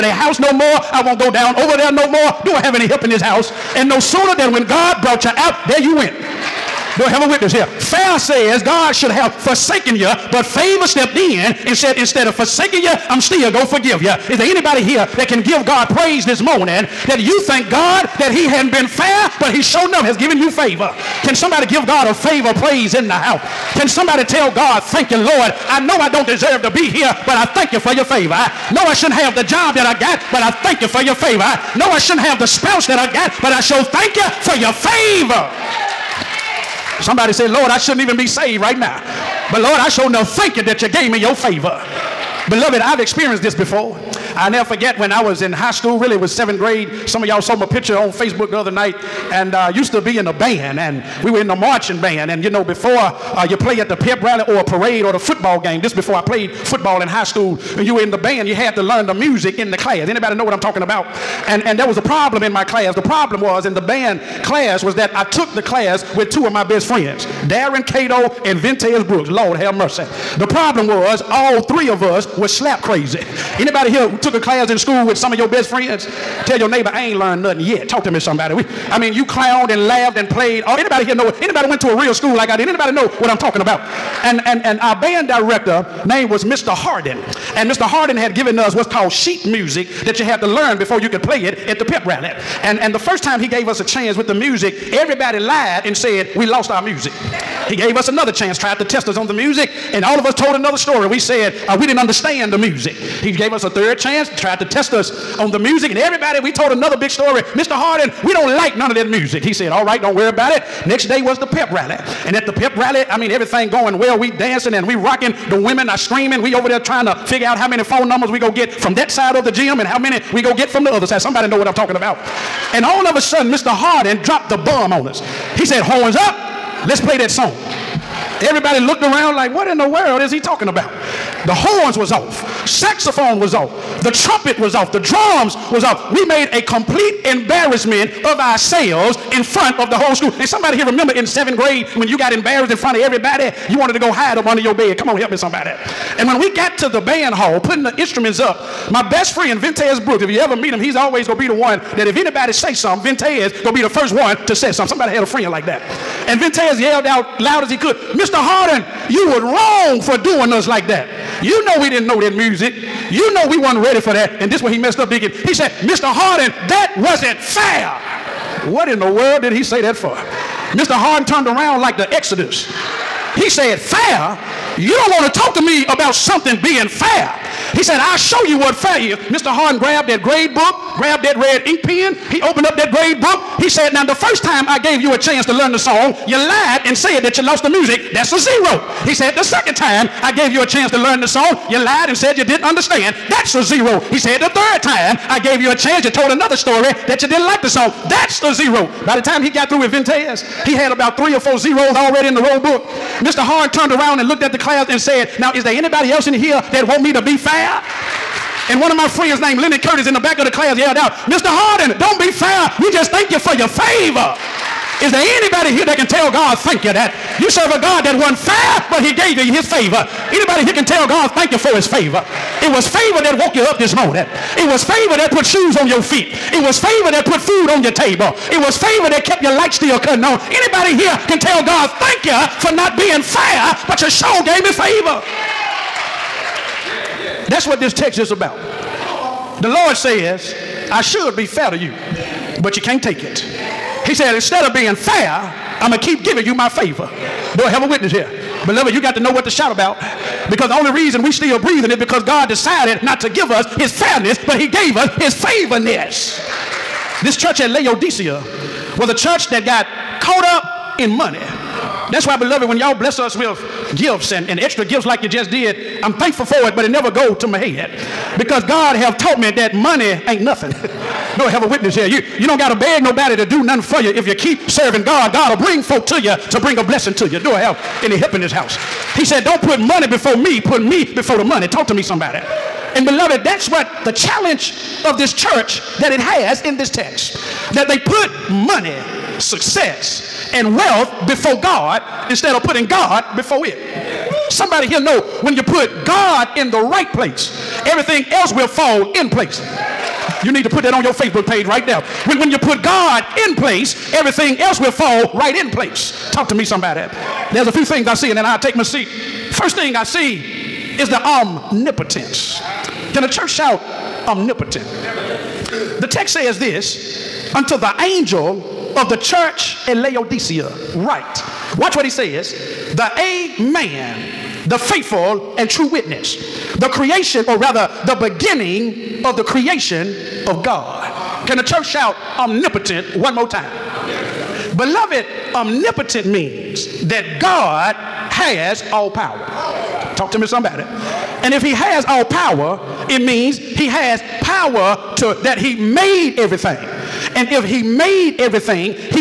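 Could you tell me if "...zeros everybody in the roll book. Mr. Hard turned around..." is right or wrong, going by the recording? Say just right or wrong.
wrong.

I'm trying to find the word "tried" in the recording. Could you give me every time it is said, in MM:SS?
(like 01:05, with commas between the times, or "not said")
01:38, 01:44.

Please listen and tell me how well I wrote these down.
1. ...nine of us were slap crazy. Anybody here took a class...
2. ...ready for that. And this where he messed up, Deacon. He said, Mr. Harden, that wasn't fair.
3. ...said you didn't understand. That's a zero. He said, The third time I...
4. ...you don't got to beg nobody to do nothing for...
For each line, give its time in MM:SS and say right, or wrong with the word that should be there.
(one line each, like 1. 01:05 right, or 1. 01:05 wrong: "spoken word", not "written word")
1. 01:11 wrong: "three", not "nine"
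2. 02:43 right
3. 03:12 right
4. 04:32 right.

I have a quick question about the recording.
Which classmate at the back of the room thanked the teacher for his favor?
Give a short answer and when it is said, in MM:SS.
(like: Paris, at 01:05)
Leonard Curtis, at 03:29.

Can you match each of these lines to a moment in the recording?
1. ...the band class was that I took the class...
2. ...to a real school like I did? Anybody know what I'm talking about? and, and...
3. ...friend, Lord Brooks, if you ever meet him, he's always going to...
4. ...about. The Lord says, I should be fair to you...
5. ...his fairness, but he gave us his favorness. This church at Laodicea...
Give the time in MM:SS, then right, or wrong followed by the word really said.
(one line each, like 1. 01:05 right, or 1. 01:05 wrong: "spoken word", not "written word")
1. 01:03 right
2. 01:21 right
3. 02:29 wrong: "Vintez", not "Lord"
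4. 03:58 right
5. 04:13 right.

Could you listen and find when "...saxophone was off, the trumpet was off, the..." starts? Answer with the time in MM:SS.
02:12.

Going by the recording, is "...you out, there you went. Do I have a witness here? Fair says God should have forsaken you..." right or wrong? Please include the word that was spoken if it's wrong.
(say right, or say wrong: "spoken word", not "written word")
right.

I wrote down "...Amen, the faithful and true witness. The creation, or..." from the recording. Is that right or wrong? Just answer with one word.
right.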